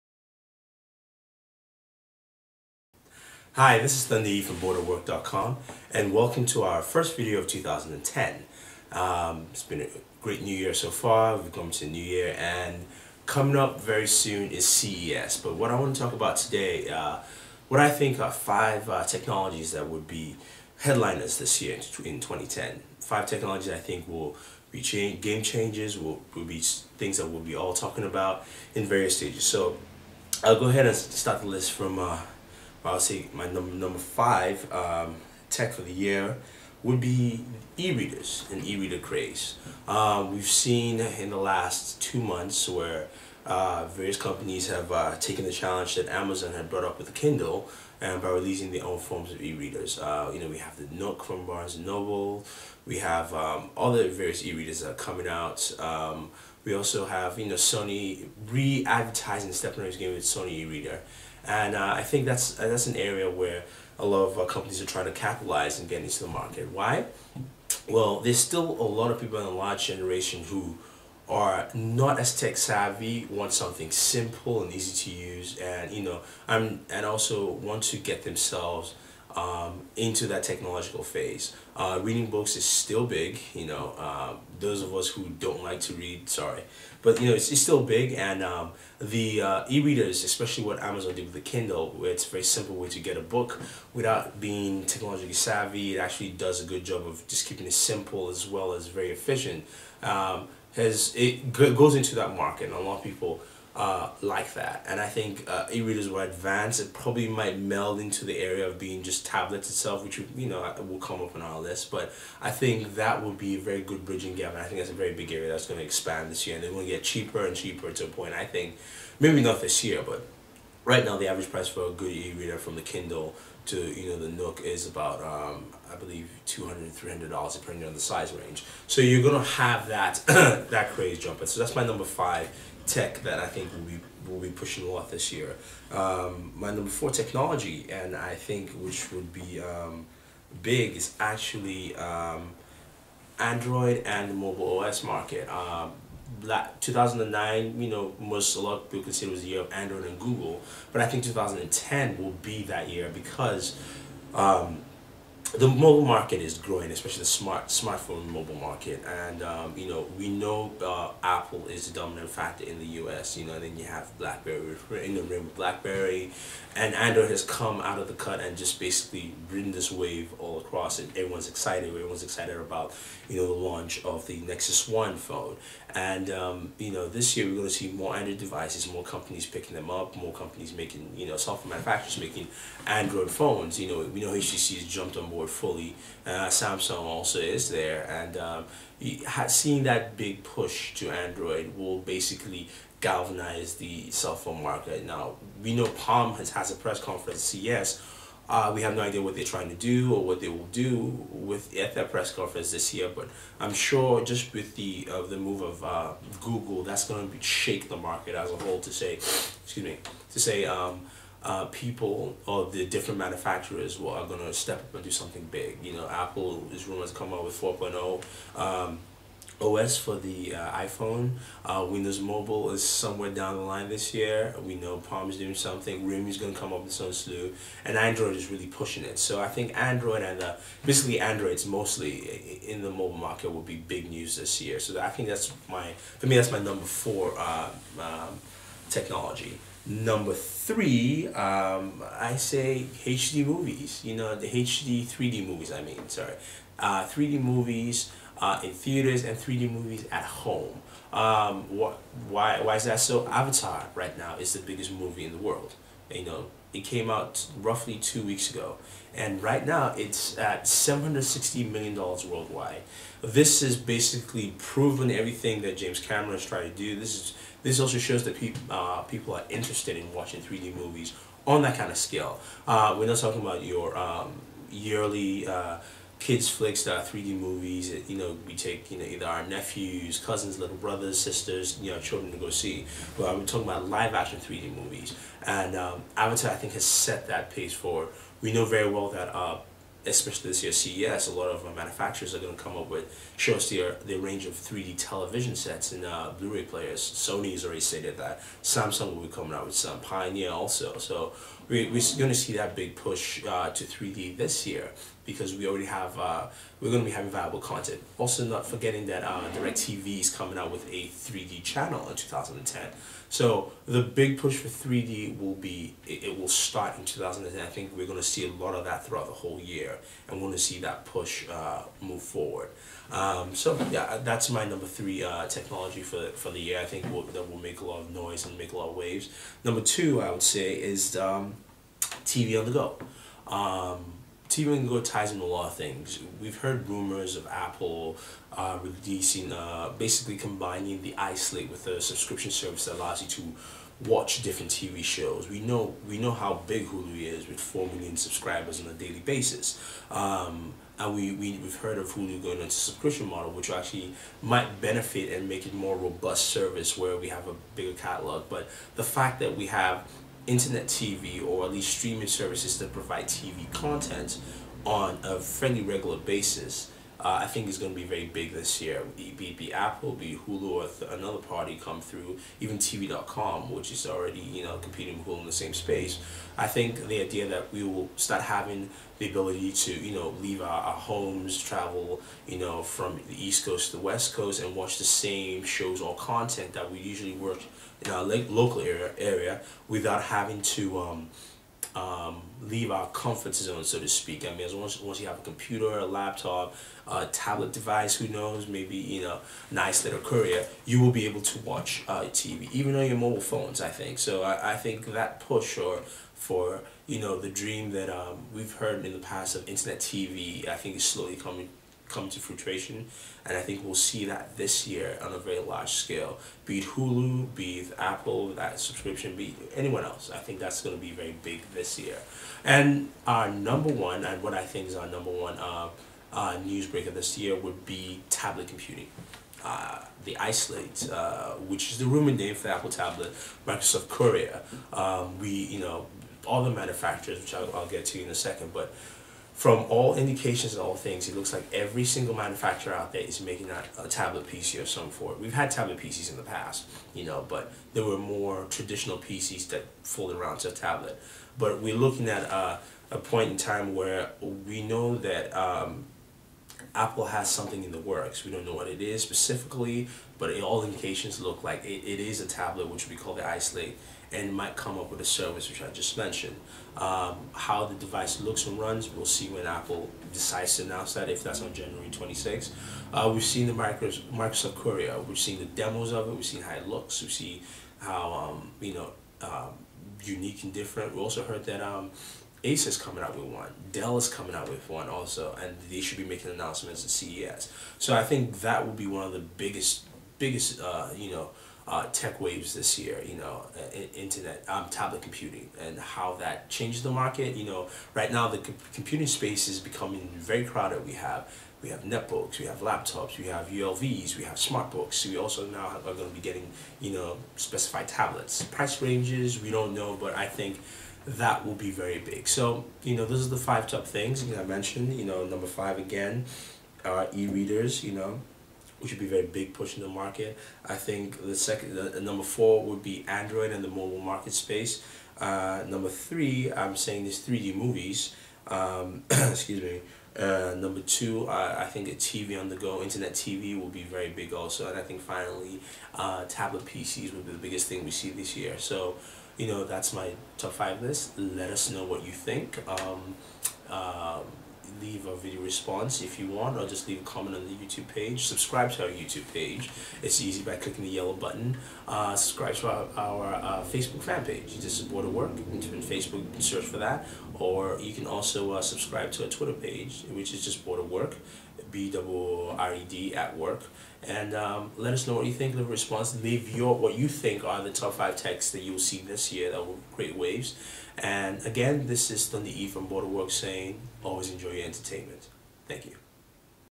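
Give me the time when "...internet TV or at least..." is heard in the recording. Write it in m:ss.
6:00.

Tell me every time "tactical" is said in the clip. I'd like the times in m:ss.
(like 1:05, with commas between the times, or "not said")
not said.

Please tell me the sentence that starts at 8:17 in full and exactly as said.
You know, right now the computing space is becoming very crowded.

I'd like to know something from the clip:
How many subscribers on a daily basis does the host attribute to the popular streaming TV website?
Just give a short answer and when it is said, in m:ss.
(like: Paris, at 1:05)
4 million, at 5:47.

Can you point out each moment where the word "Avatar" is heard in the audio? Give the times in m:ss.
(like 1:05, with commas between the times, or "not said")
4:13, 4:46.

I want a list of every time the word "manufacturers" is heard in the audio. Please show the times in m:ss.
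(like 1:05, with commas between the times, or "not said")
3:01, 3:33, 4:51, 7:16, 7:22.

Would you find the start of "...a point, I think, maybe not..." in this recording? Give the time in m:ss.
1:58.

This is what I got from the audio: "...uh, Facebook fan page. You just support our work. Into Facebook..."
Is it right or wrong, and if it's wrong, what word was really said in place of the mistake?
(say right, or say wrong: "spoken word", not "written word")
right.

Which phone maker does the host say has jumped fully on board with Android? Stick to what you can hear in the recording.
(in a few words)
HTC.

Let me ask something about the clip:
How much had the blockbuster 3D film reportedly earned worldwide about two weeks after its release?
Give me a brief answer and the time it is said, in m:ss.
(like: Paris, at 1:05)
$760 million, at 4:20.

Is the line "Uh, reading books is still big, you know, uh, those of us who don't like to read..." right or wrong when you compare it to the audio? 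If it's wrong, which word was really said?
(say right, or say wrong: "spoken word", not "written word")
right.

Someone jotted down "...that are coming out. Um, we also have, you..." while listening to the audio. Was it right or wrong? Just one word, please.
right.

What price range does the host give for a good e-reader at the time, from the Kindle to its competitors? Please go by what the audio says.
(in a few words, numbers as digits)
$200-$300.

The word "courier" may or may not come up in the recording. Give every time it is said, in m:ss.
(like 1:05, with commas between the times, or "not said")
6:40, 7:14, 7:54.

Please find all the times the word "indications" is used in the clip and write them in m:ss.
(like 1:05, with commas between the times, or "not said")
7:20, 7:40.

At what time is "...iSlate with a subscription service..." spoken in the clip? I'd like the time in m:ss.
5:41.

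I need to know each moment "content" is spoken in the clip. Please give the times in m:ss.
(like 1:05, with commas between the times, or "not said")
5:07, 6:03, 6:26.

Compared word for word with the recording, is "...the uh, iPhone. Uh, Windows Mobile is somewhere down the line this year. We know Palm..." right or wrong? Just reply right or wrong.
right.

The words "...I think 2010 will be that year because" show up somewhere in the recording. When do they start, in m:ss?
2:31.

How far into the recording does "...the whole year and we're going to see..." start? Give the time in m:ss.
5:19.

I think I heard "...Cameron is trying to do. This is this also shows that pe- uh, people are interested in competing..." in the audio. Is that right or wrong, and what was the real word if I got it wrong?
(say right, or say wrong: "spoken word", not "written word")
wrong: "watching", not "competing".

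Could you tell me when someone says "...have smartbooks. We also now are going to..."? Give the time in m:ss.
8:24.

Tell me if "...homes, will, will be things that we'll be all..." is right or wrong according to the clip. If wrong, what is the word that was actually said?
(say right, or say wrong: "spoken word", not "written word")
wrong: "changes", not "homes".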